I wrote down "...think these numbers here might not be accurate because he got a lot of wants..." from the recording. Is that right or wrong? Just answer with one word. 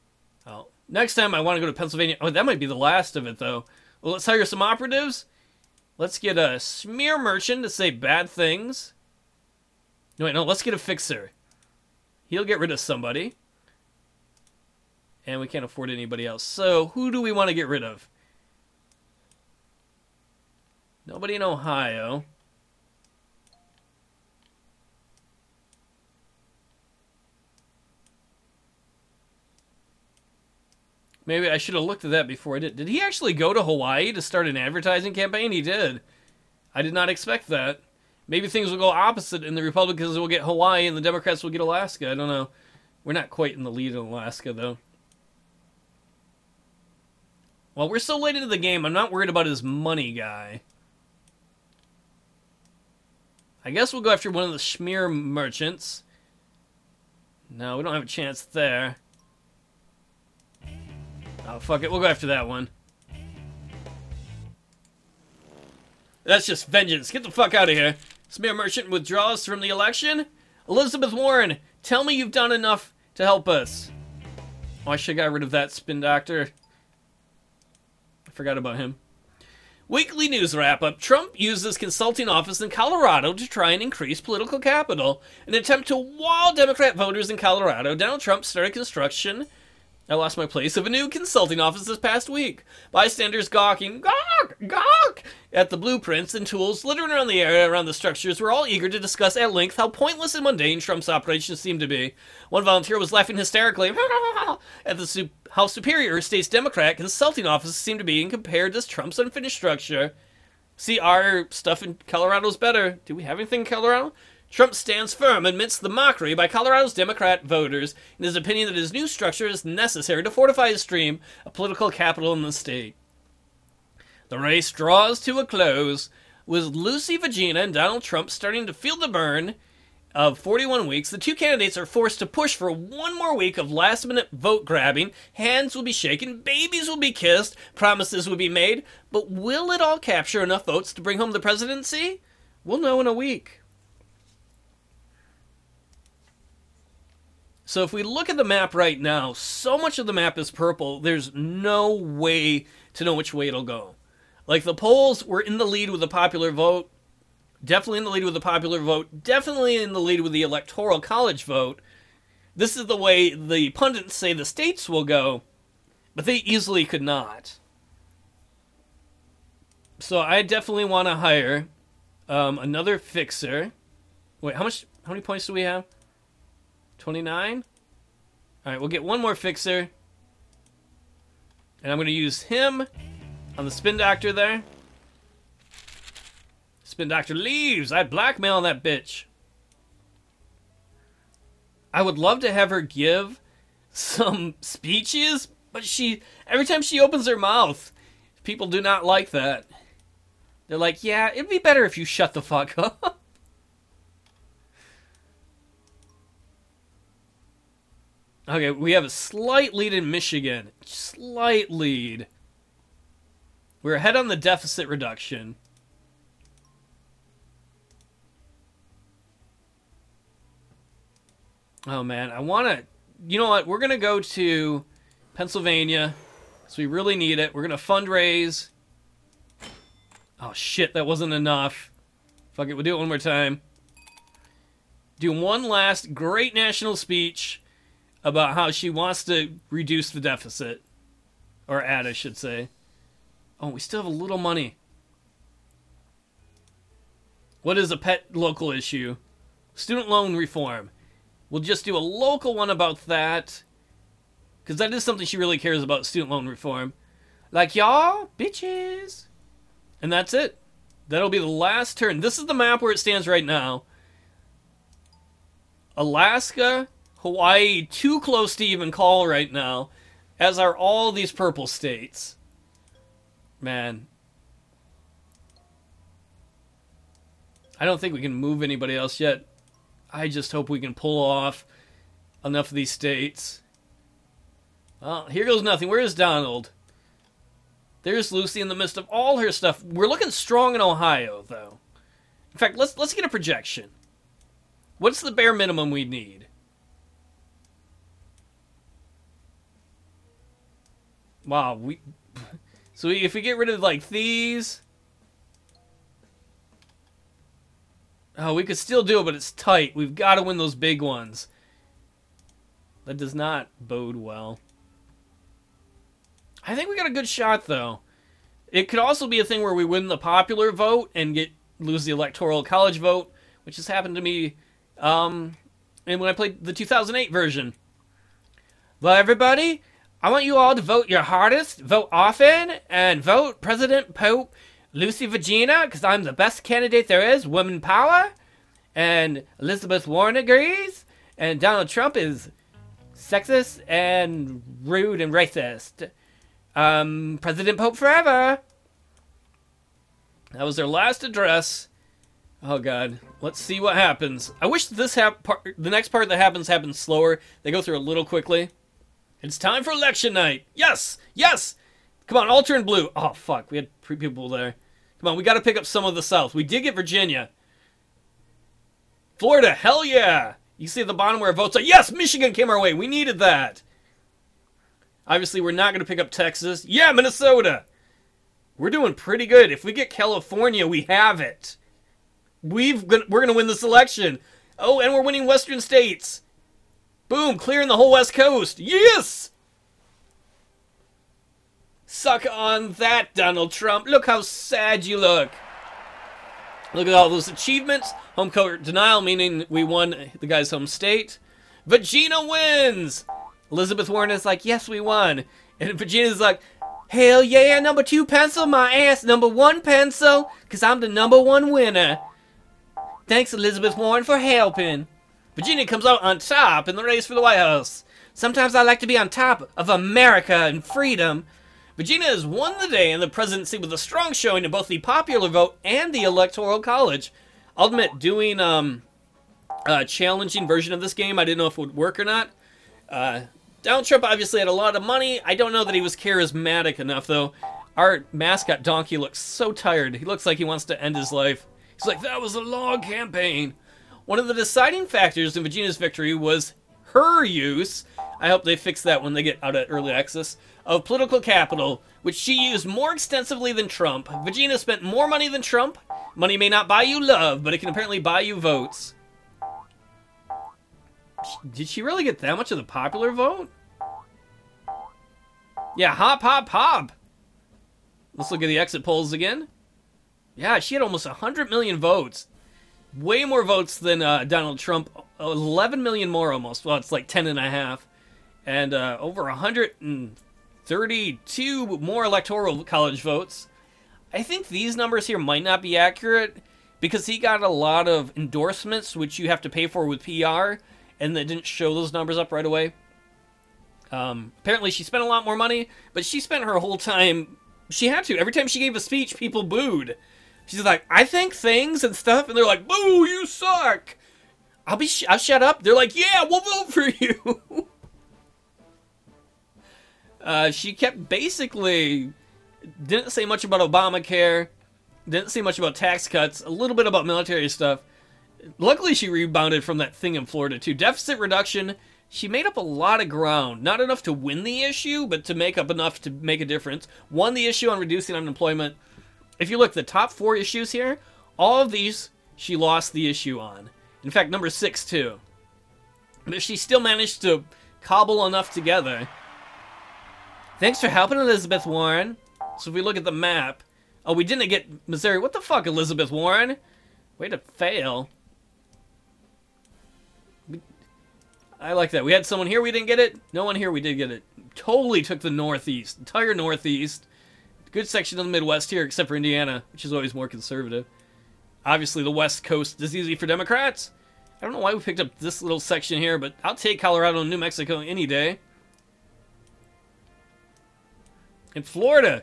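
wrong.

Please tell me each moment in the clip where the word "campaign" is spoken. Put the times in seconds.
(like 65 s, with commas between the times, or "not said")
35 s, 443 s.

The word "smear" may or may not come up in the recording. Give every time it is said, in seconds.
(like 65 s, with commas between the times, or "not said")
6 s, 54 s, 68 s.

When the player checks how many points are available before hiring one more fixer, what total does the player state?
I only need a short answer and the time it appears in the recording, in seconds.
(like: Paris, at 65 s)
29, at 176 s.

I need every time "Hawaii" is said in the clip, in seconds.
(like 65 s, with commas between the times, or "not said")
33 s, 40 s, 267 s.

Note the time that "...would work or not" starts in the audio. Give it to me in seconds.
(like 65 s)
431 s.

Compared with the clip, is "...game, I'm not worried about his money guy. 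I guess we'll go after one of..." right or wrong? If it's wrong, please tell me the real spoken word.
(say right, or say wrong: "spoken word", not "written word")
right.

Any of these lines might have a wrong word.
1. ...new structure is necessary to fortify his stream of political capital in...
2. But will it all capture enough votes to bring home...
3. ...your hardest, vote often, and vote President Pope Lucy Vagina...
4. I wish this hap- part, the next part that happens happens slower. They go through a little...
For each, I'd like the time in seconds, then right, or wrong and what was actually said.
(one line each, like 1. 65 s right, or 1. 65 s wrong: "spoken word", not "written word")
1. 118 s right
2. 139 s right
3. 331 s right
4. 354 s right.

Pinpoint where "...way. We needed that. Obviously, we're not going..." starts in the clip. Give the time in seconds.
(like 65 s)
372 s.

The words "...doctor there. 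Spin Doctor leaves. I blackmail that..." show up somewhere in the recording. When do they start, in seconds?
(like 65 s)
183 s.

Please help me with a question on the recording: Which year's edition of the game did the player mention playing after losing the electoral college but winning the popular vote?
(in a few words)
2008.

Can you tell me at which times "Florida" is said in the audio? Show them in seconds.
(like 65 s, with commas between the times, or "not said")
369 s, 520 s, 571 s.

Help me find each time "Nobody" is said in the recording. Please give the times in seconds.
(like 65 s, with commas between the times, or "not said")
21 s.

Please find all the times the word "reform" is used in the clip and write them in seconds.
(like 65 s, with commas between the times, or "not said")
250 s, 256 s.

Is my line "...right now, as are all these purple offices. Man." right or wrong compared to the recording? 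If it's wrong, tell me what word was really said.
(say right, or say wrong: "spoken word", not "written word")
wrong: "states", not "offices".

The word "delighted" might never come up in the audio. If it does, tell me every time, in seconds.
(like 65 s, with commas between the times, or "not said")
not said.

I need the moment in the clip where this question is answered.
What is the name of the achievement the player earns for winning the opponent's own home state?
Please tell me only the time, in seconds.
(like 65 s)
398 s.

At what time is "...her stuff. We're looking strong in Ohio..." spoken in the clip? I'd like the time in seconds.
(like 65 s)
289 s.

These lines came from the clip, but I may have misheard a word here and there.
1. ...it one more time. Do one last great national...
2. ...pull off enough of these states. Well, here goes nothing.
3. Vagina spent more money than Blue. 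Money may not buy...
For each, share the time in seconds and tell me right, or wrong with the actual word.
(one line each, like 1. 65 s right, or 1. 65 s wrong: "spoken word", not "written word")
1. 232 s right
2. 280 s right
3. 454 s wrong: "Trump", not "Blue".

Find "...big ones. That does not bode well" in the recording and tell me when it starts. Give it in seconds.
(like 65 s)
310 s.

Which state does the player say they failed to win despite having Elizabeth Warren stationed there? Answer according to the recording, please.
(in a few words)
Missouri.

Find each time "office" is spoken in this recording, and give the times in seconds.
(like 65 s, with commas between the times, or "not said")
82 s, 91 s, 107 s.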